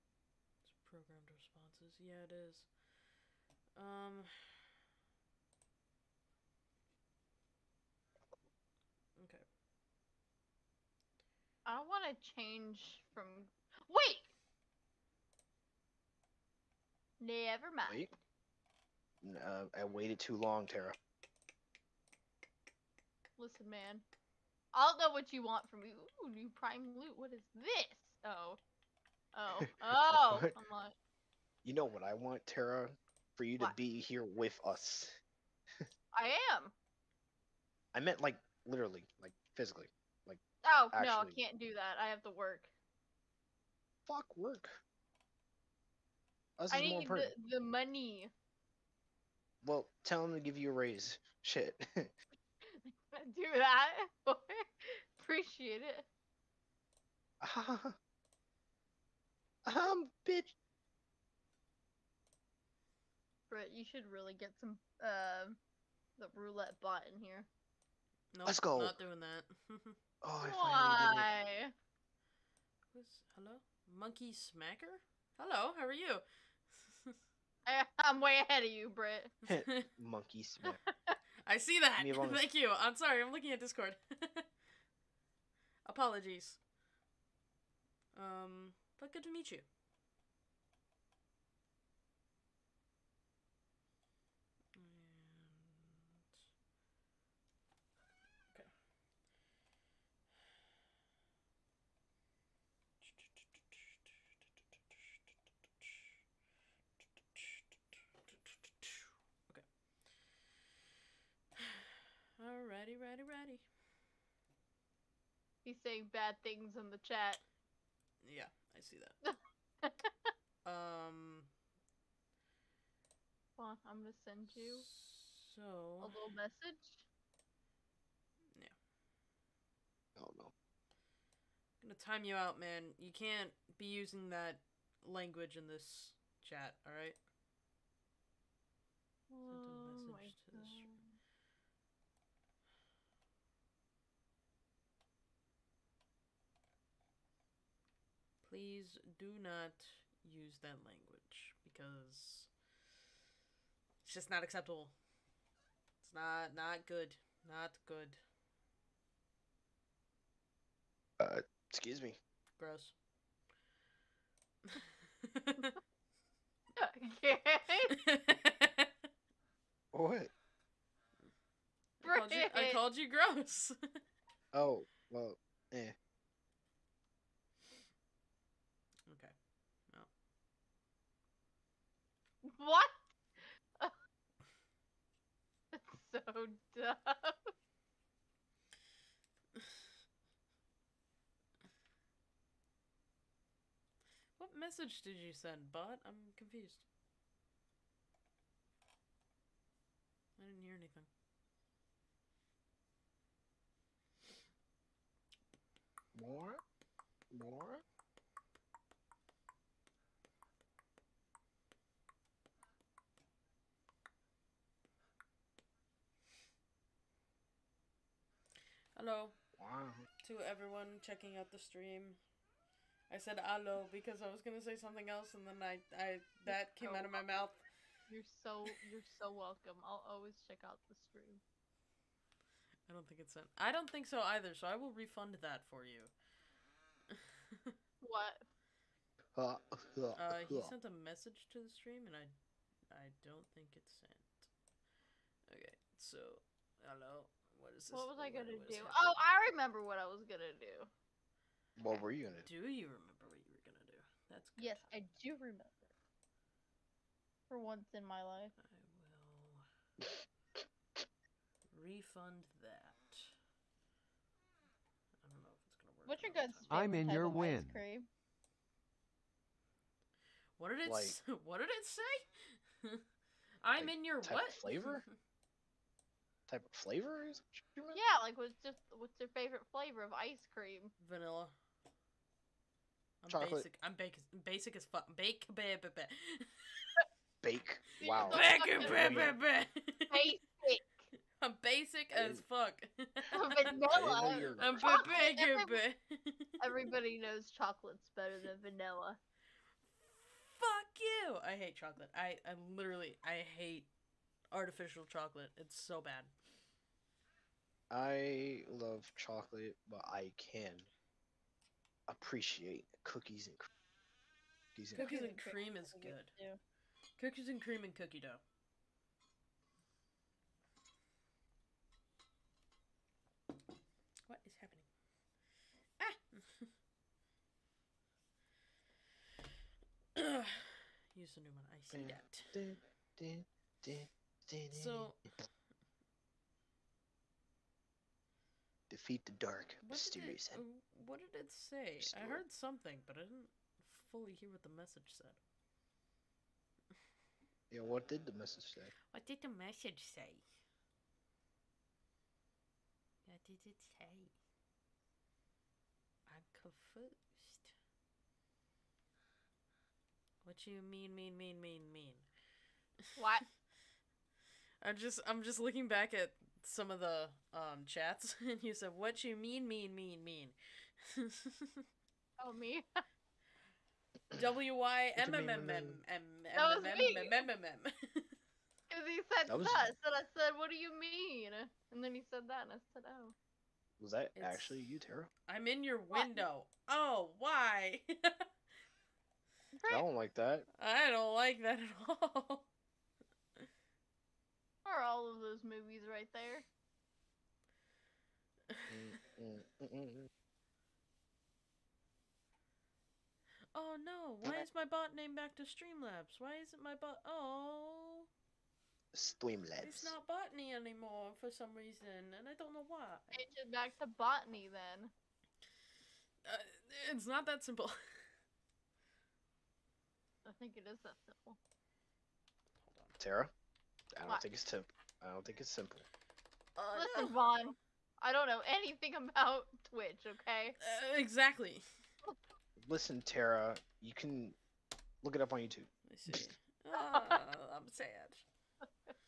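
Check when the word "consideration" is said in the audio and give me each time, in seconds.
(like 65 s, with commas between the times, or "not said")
not said.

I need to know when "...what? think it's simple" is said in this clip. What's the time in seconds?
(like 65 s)
424 s.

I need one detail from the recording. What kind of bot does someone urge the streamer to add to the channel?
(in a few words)
roulette bot.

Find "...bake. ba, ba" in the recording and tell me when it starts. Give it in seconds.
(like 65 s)
288 s.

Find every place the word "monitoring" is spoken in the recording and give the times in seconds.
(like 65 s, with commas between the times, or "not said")
not said.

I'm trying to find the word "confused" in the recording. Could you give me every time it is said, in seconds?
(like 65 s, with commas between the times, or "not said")
196 s, 356 s.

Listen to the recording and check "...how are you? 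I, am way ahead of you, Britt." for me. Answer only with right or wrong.
right.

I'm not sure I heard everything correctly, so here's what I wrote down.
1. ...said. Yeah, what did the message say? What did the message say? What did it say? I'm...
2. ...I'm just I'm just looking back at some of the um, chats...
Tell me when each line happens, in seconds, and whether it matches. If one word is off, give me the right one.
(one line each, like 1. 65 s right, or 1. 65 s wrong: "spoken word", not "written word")
1. 345 s right
2. 364 s right.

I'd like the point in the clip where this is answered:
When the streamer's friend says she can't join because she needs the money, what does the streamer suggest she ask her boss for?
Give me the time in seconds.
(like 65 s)
50 s.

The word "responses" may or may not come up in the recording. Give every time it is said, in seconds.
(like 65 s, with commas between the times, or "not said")
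1 s.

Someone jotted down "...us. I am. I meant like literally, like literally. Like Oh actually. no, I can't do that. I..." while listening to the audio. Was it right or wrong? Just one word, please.
wrong.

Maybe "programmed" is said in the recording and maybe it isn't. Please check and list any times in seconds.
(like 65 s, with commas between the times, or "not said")
0 s.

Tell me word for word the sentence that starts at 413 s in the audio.
Change it back to botany then.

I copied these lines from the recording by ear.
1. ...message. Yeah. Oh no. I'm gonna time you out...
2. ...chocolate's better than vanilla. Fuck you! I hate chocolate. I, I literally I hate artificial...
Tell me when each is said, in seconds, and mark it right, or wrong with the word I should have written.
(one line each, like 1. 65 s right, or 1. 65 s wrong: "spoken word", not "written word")
1. 126 s right
2. 297 s right.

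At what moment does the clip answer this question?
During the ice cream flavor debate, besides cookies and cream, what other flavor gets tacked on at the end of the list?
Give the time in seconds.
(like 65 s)
317 s.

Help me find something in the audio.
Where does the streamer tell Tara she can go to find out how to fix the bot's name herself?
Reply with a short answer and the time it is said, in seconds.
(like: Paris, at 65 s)
YouTube, at 435 s.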